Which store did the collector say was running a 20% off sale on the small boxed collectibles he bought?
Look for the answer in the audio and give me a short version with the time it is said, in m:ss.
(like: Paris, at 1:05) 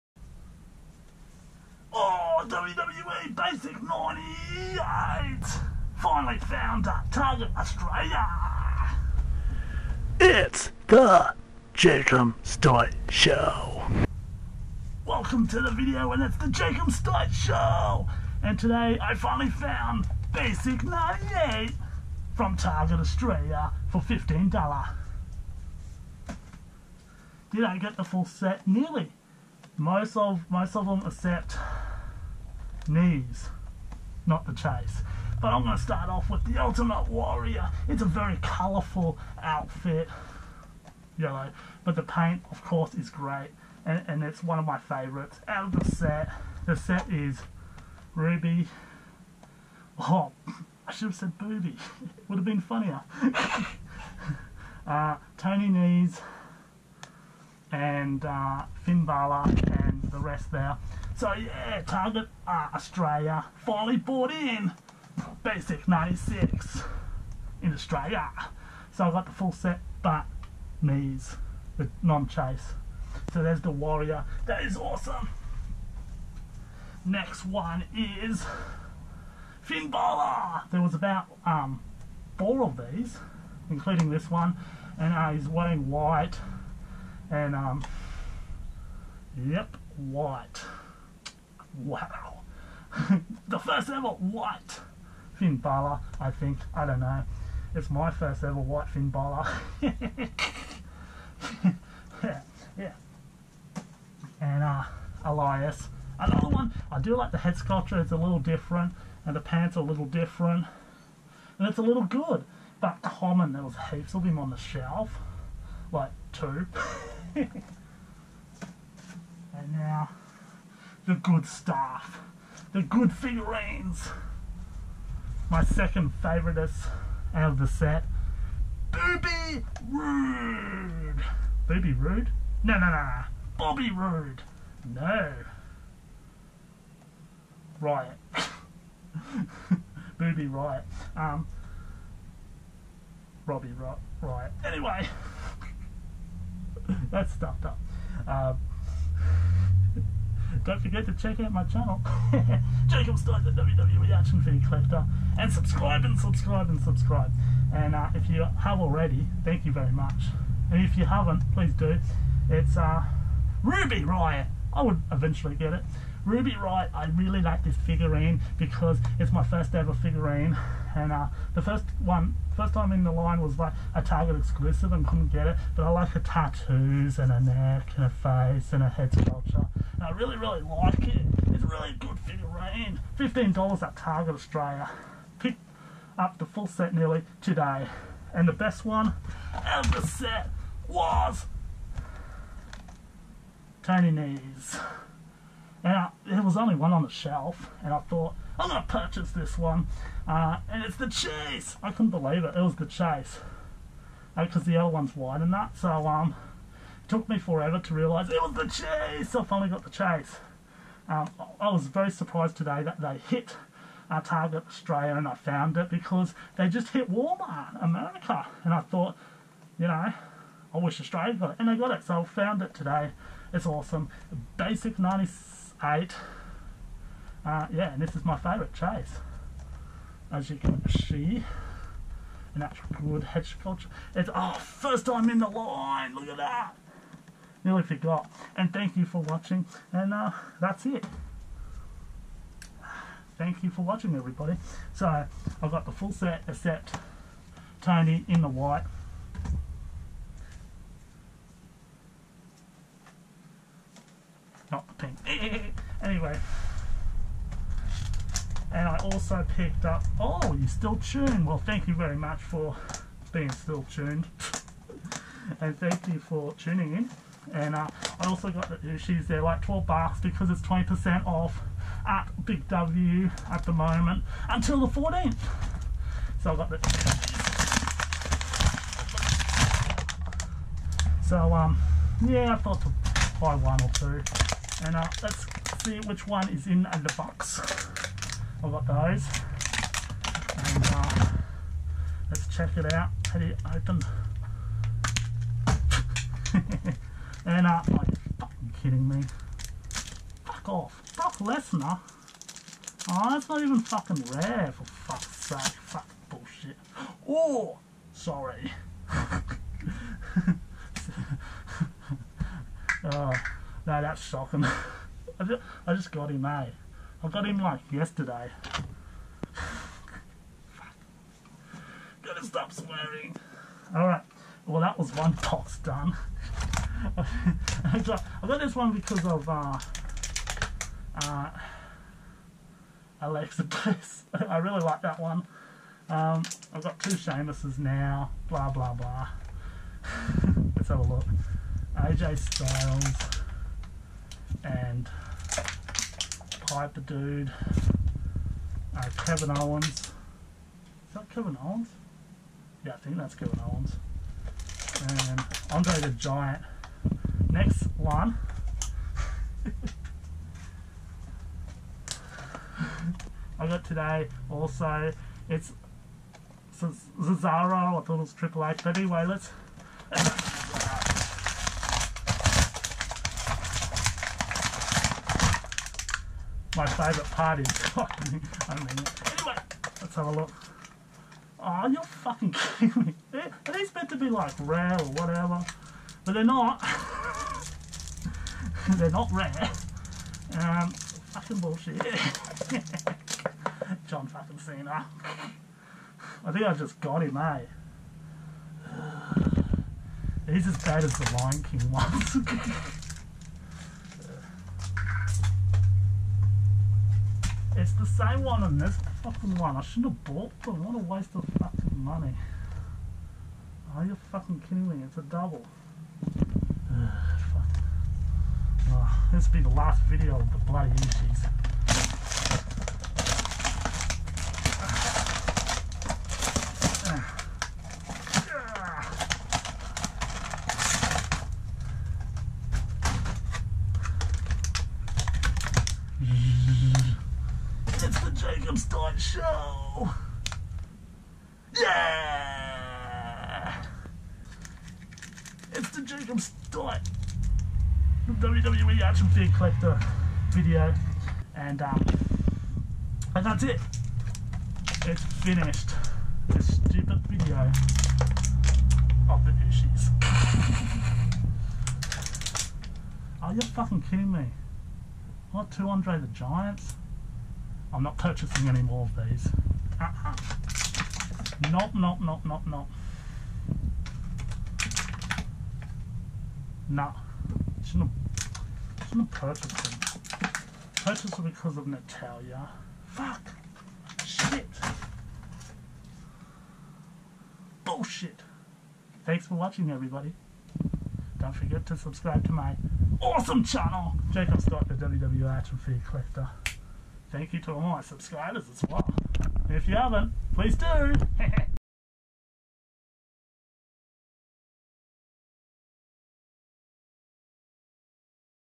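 Big W, at 4:32.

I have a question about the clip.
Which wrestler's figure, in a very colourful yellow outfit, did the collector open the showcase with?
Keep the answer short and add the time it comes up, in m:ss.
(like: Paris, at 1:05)
Ultimate Warrior, at 0:36.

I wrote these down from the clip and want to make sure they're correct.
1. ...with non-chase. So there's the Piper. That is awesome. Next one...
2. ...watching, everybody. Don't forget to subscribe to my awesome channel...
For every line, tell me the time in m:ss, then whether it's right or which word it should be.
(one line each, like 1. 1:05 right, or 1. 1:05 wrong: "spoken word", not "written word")
1. 1:11 wrong: "Warrior", not "Piper"
2. 8:09 right.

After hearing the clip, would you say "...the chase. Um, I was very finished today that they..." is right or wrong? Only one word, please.
wrong.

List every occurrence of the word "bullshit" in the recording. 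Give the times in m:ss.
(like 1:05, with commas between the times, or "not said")
5:06, 6:31, 8:07.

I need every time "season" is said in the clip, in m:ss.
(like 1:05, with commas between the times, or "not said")
not said.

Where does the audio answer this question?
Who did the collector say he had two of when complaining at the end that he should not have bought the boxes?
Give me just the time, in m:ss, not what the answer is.
7:45.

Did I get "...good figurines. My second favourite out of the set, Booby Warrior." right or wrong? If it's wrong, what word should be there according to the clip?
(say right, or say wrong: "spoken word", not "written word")
wrong: "Rude", not "Warrior".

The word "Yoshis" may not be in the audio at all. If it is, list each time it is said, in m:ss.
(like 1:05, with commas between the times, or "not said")
7:00.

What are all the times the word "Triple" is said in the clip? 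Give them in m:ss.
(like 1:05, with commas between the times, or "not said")
6:08.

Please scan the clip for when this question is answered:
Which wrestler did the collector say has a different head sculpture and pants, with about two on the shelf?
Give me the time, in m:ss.
1:45.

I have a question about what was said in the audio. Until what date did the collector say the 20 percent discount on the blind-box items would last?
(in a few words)
the 14th.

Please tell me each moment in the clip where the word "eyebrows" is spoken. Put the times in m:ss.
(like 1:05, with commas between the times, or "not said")
not said.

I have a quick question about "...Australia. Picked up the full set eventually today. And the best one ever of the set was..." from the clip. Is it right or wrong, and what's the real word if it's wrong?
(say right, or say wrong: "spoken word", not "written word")
wrong: "nearly", not "eventually".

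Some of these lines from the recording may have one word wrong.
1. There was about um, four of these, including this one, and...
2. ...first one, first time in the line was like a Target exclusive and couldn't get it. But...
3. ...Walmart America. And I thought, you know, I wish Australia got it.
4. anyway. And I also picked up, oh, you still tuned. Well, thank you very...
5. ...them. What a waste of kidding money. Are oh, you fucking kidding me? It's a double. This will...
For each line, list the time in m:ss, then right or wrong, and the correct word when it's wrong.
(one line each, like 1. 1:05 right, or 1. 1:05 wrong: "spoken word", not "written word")
1. 1:20 right
2. 2:51 right
3. 3:37 right
4. 4:16 right
5. 6:50 wrong: "fucking", not "kidding".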